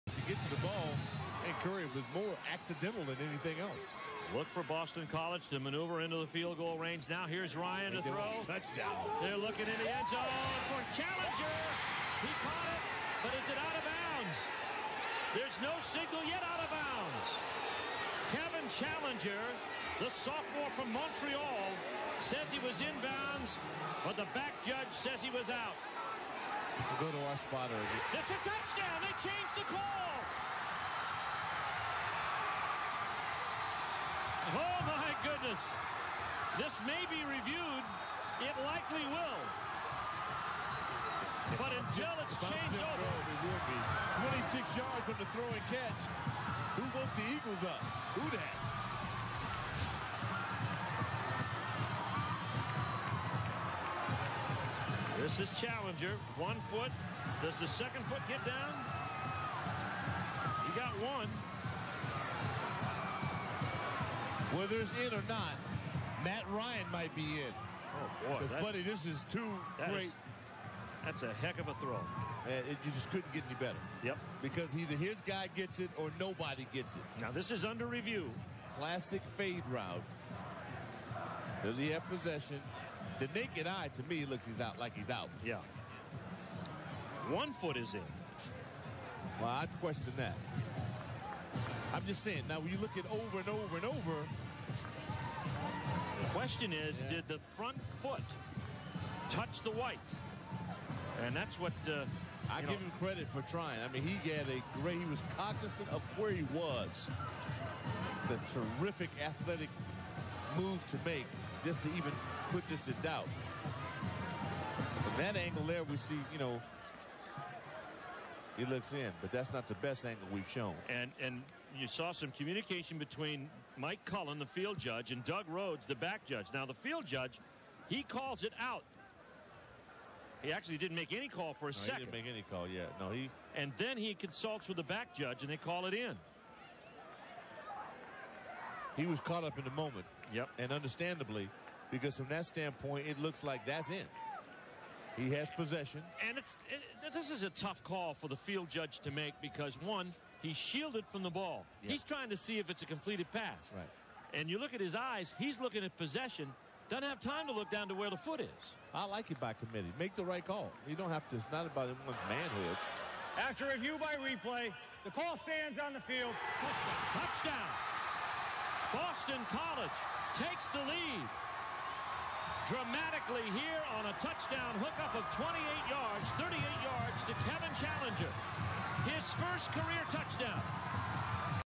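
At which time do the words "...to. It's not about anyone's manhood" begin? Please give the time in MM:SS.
02:41.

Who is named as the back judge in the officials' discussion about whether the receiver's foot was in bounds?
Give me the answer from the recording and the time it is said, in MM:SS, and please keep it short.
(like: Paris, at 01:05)
Doug Rhodes, at 02:05.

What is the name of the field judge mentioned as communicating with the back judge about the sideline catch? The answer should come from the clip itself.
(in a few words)
Mike Cullen.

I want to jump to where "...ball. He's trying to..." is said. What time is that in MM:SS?
02:31.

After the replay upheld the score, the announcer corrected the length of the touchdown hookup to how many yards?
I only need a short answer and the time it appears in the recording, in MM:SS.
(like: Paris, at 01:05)
38, at 02:56.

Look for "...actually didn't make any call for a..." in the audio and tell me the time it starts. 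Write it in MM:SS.
02:10.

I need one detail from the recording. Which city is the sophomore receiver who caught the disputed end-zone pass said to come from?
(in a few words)
Montreal.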